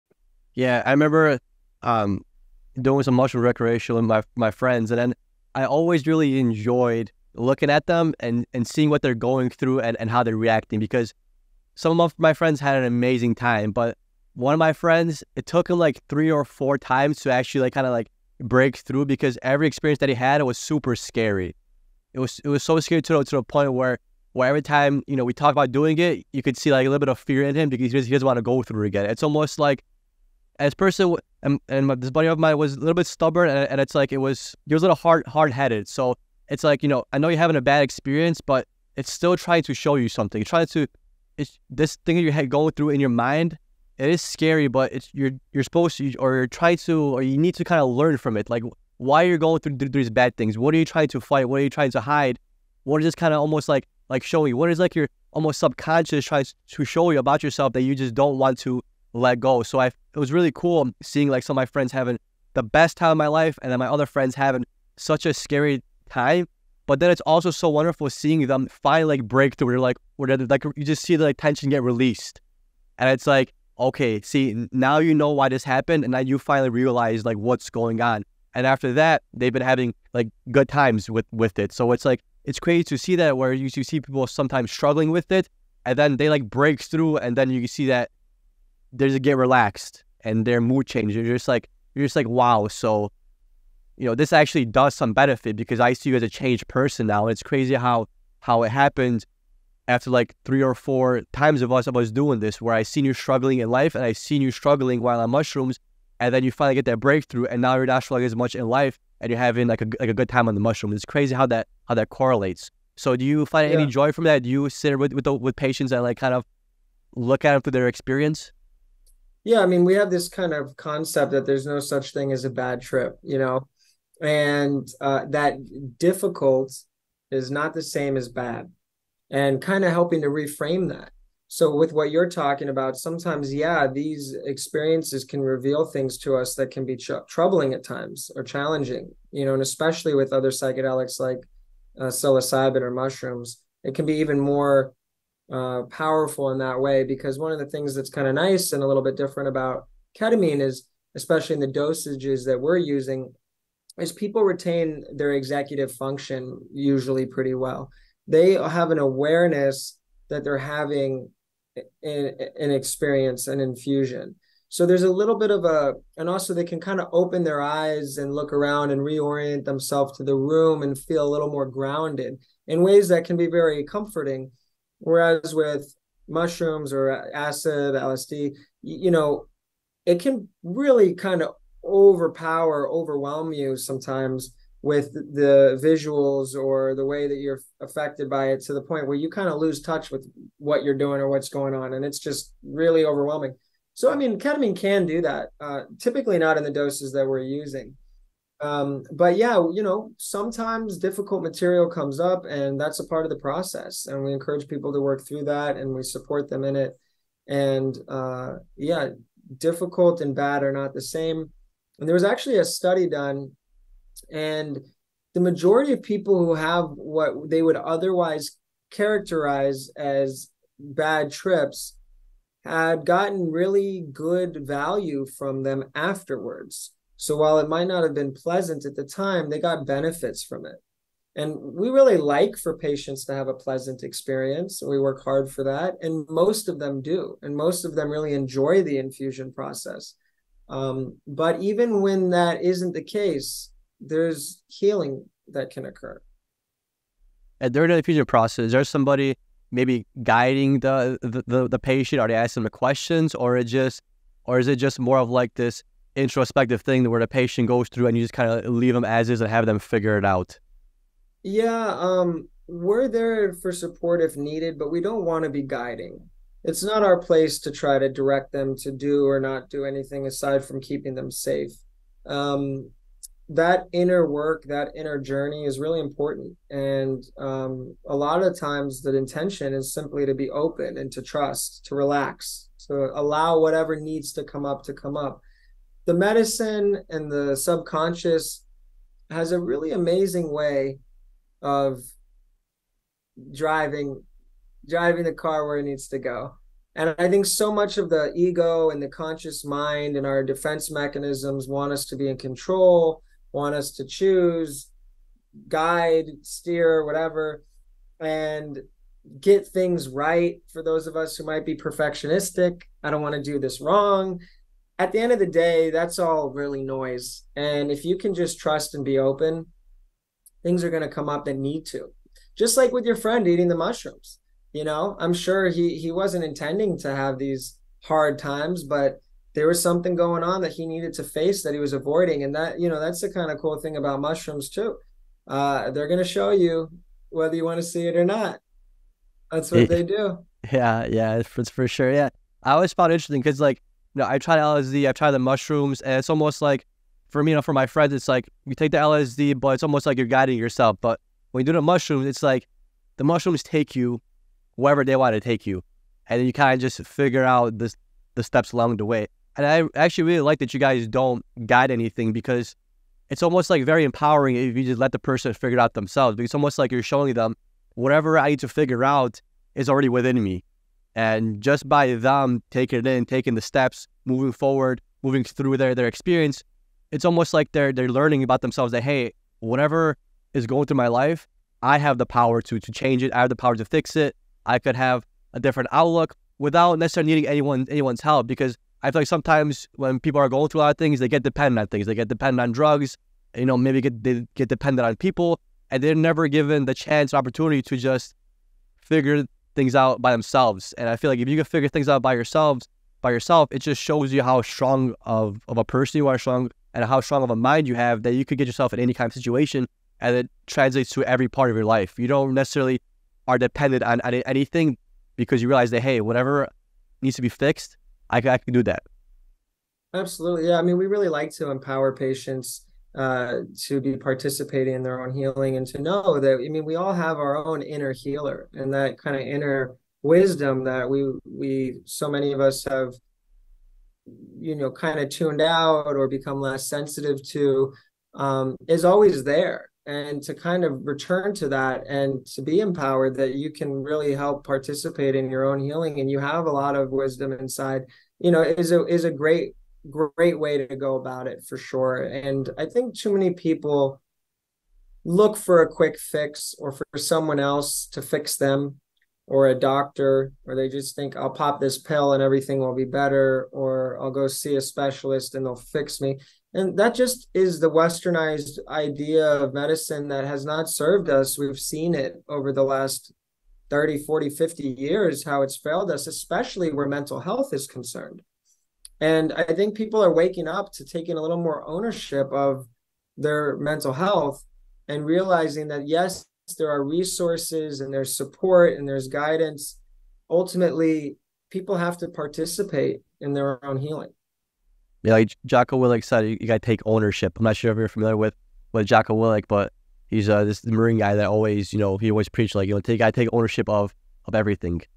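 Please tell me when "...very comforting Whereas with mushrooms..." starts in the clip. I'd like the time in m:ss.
2:53.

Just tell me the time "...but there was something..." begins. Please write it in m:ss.
5:28.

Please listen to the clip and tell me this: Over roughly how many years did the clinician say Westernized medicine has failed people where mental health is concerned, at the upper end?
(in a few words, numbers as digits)
50.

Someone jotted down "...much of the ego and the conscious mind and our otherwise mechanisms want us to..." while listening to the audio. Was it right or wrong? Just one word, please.
wrong.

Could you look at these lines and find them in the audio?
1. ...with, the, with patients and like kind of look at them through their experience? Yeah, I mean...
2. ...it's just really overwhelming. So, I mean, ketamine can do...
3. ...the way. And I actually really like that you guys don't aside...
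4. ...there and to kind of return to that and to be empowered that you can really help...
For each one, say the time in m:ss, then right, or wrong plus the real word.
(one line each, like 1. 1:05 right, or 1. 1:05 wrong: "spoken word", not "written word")
1. 1:55 right
2. 3:12 right
3. 5:58 wrong: "guide", not "aside"
4. 7:19 right.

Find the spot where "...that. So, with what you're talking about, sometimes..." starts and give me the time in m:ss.
2:10.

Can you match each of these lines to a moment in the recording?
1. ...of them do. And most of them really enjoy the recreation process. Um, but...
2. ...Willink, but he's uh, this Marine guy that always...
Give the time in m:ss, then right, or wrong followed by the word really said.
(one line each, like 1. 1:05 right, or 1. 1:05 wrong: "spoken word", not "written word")
1. 3:56 wrong: "infusion", not "recreation"
2. 8:19 right.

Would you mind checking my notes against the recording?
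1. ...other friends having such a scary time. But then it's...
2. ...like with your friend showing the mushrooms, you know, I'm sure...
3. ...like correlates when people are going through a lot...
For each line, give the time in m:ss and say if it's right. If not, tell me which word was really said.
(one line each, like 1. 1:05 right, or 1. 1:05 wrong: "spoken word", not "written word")
1. 1:03 right
2. 5:22 wrong: "eating", not "showing"
3. 6:29 wrong: "sometimes", not "correlates".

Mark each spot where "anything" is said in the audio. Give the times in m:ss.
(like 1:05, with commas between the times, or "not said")
4:29, 6:01, 6:54.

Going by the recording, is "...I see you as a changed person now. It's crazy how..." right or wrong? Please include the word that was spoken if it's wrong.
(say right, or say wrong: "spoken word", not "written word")
right.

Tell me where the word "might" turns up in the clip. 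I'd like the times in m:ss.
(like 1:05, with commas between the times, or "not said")
3:47, 5:11.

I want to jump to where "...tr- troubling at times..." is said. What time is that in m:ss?
2:16.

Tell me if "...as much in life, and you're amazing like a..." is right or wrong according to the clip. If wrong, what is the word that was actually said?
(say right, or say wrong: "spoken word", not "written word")
wrong: "having", not "amazing".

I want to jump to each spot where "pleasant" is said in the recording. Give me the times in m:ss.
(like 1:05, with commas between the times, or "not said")
3:48, 3:53.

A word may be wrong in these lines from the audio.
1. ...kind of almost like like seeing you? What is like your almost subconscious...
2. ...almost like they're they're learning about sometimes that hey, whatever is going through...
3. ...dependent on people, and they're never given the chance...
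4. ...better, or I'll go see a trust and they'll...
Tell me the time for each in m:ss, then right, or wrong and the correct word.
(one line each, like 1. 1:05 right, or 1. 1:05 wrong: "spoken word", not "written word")
1. 0:53 wrong: "showing", not "seeing"
2. 6:17 wrong: "themselves", not "sometimes"
3. 6:34 right
4. 7:43 wrong: "specialist", not "trust".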